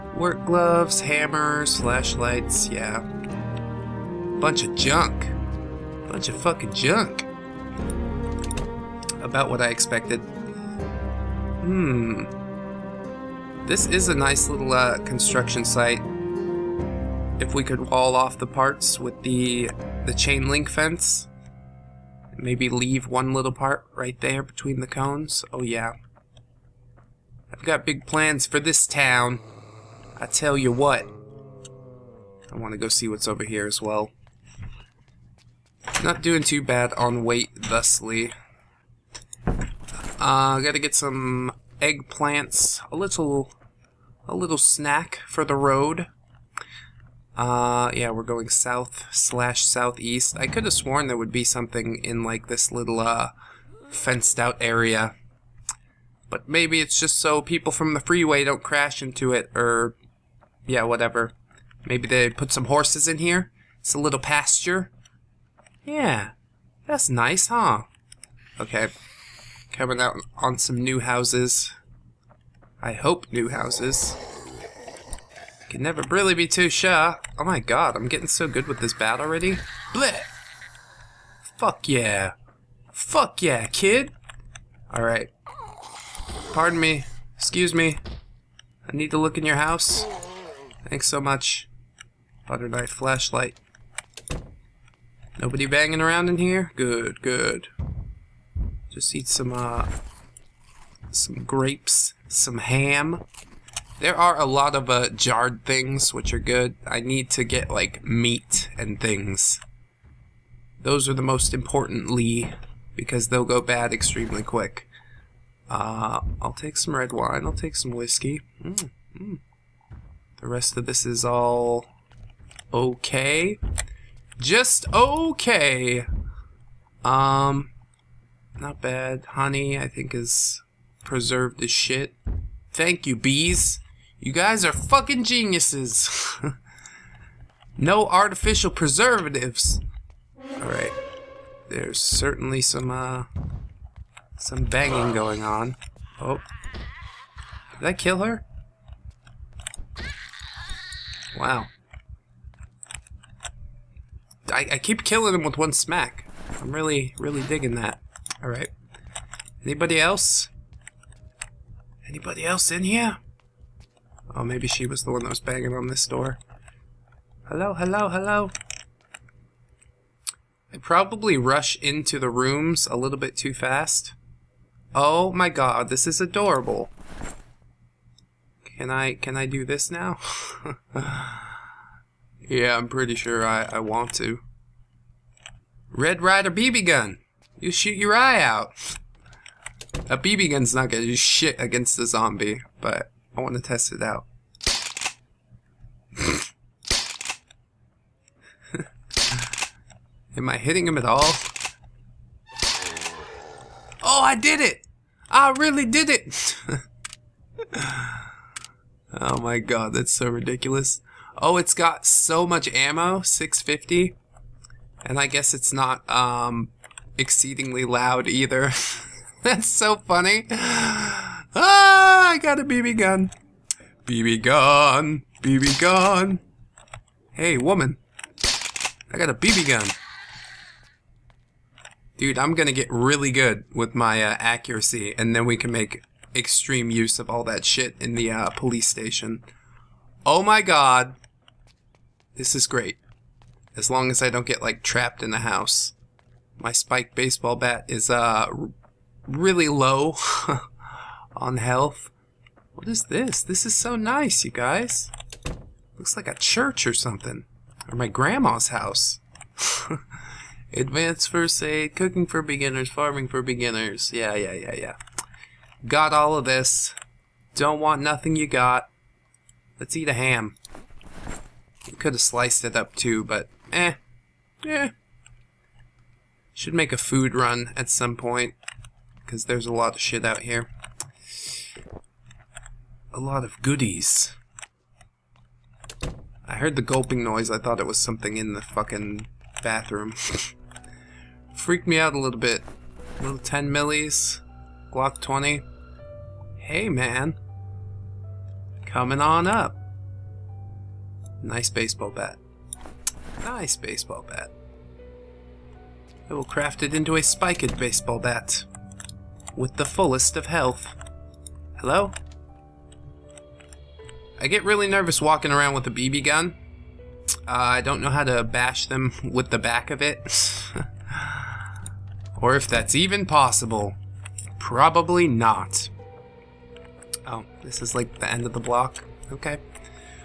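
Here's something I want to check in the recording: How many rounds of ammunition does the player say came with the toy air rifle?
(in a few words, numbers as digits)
650.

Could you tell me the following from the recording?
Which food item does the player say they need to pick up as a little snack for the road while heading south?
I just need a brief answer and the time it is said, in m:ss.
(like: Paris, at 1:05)
Eggplants, at 0:41.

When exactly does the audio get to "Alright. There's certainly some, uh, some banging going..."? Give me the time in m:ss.
2:20.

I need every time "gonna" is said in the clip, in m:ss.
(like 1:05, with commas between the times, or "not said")
3:10, 3:52.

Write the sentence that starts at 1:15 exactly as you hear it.
Can never really be too sure.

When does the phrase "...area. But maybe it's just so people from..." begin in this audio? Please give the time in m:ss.
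0:54.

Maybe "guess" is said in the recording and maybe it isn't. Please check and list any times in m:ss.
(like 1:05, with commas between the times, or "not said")
3:35.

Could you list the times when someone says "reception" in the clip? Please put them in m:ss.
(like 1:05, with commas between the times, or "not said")
not said.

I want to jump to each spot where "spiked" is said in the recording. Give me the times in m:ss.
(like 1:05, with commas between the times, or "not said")
4:06, 5:07.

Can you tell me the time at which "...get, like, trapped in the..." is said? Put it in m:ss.
4:04.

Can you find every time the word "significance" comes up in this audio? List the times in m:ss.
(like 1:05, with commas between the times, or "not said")
not said.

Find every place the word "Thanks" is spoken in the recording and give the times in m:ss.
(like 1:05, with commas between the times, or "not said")
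1:30, 2:12.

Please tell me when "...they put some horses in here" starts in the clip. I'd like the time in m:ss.
1:02.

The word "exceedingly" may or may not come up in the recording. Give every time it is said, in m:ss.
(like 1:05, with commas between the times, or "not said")
3:37.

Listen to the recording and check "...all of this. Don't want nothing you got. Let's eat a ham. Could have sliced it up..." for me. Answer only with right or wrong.
right.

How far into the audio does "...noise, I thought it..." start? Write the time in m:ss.
4:47.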